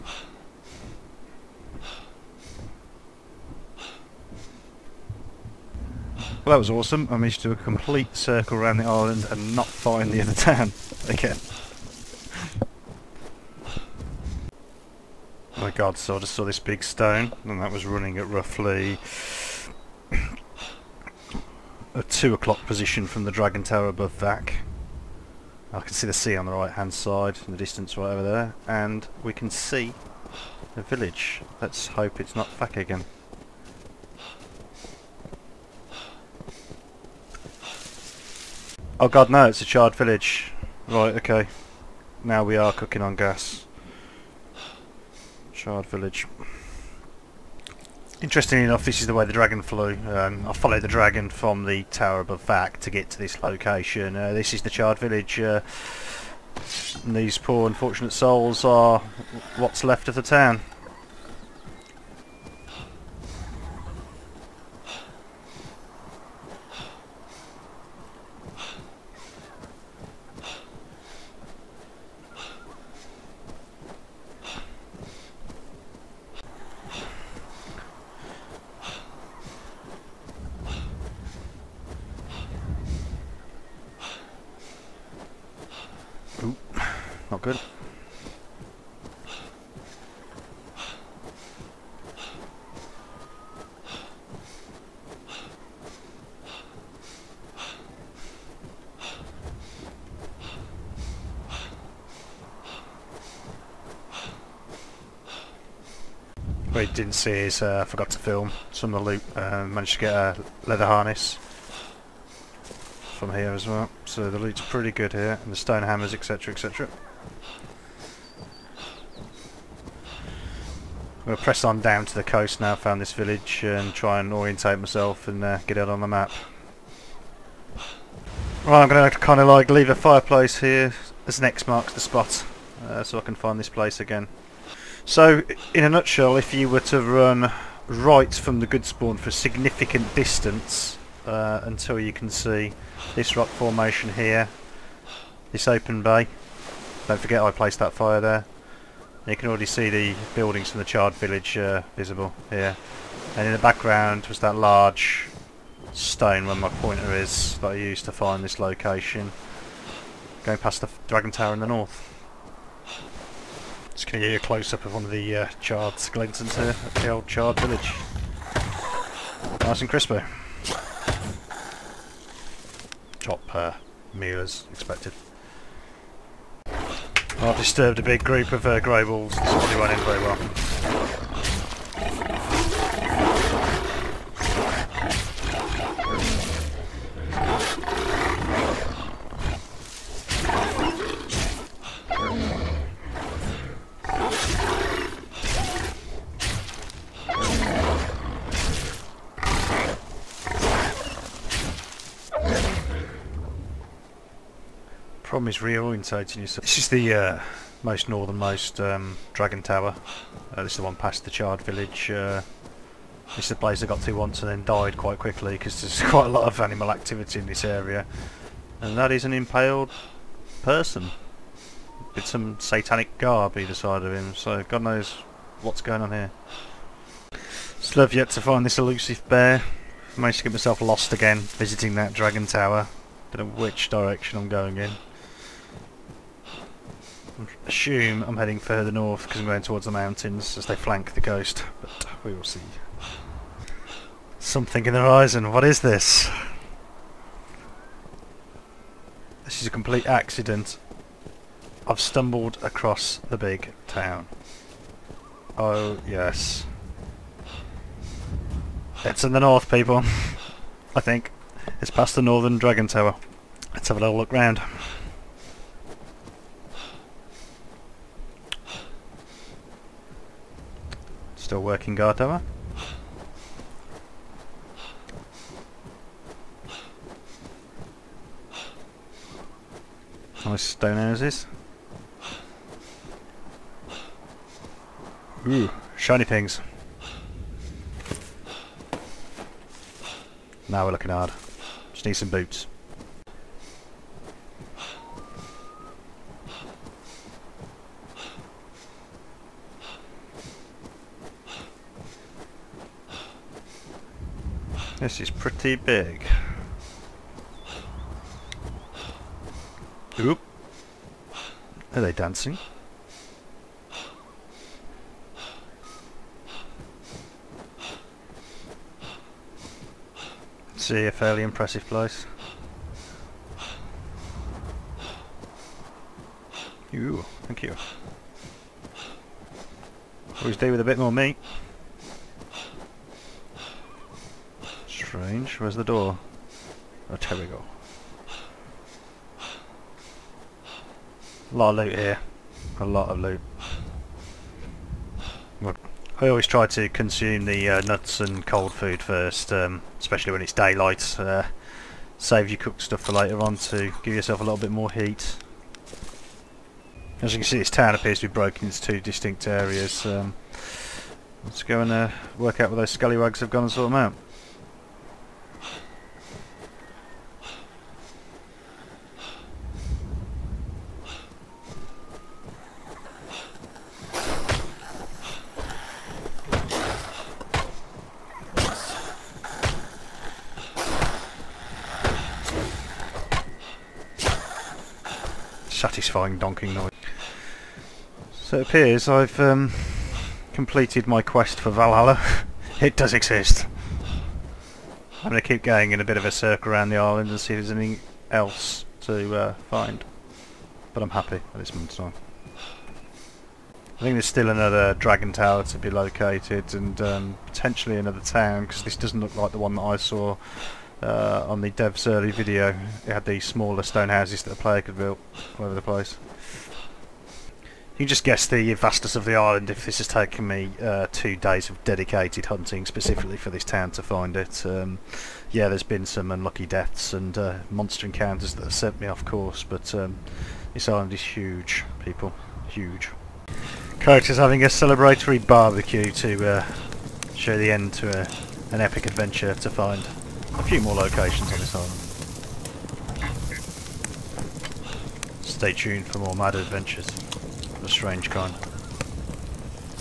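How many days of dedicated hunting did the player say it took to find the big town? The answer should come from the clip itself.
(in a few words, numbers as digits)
2.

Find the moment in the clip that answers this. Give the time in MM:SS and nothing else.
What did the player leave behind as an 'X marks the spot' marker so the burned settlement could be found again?
02:09.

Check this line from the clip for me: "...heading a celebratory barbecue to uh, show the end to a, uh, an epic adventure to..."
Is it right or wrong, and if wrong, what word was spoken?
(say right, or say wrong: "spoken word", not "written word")
wrong: "having", not "heading".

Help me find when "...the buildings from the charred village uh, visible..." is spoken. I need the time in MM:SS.
02:29.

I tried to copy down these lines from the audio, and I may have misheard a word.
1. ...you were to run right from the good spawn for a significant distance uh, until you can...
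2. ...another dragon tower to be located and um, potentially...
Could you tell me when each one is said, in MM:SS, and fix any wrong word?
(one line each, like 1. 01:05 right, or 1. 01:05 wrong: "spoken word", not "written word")
1. 02:16 right
2. 06:44 right.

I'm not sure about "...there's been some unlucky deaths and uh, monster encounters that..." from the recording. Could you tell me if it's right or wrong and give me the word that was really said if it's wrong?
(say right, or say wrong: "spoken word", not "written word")
right.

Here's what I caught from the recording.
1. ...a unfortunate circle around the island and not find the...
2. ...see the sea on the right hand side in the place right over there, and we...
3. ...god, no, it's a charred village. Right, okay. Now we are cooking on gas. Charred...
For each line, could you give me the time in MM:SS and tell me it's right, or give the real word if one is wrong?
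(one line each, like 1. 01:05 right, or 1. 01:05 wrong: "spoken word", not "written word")
1. 00:07 wrong: "complete", not "unfortunate"
2. 00:25 wrong: "distance", not "place"
3. 00:39 right.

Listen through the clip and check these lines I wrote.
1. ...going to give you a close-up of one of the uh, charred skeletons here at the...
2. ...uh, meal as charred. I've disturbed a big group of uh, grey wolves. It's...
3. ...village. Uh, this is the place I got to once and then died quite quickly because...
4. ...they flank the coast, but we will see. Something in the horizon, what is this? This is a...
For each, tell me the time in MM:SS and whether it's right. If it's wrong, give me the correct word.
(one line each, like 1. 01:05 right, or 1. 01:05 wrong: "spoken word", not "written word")
1. 02:44 right
2. 02:53 wrong: "expected", not "charred"
3. 03:31 right
4. 04:00 right.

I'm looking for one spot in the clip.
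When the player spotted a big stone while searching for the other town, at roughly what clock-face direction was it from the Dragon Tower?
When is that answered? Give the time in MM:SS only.
00:22.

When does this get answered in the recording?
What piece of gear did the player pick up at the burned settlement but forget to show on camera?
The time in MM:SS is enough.
01:50.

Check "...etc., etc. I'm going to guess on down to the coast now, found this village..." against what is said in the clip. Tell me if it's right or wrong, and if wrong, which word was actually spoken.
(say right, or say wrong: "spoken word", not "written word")
wrong: "press", not "guess".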